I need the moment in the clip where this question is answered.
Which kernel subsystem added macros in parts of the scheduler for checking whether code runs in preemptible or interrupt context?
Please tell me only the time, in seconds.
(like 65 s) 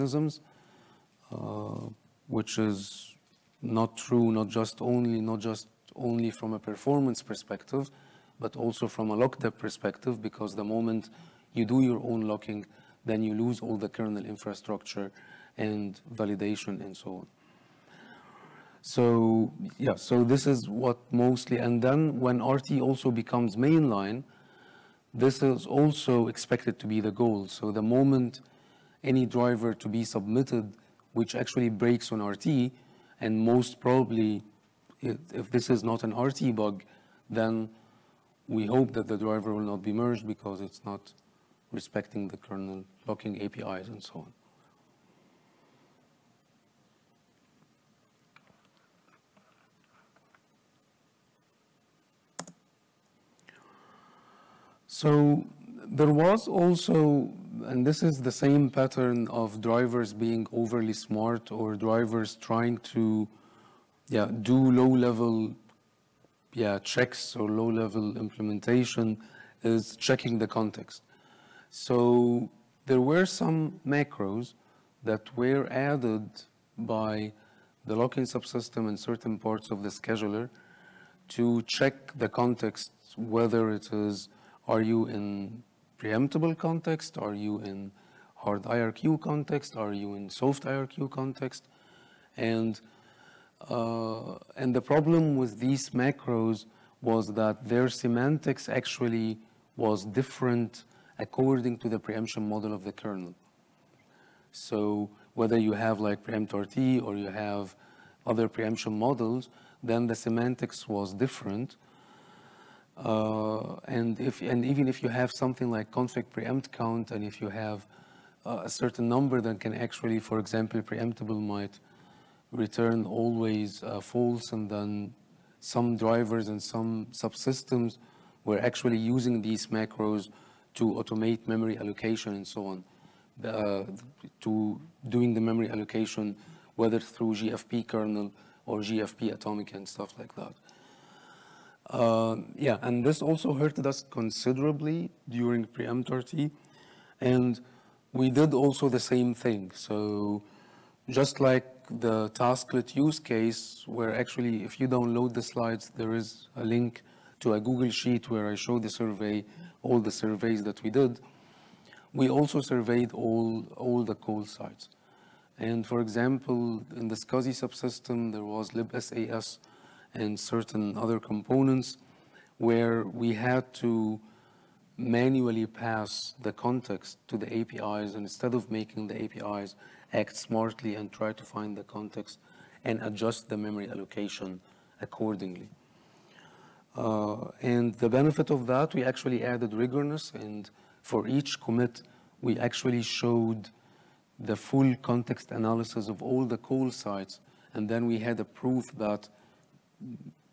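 77 s.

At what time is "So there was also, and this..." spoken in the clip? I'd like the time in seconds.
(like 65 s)
55 s.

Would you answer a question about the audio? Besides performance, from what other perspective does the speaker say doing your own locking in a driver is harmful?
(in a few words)
lockdep.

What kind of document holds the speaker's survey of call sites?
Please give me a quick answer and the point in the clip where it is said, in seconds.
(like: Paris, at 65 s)
Google Sheet, at 157 s.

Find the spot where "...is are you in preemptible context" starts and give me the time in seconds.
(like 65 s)
83 s.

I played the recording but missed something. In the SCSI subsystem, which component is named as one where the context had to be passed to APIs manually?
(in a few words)
libsas.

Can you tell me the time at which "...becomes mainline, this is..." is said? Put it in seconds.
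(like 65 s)
23 s.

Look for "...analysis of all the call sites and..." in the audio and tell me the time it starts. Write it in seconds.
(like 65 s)
195 s.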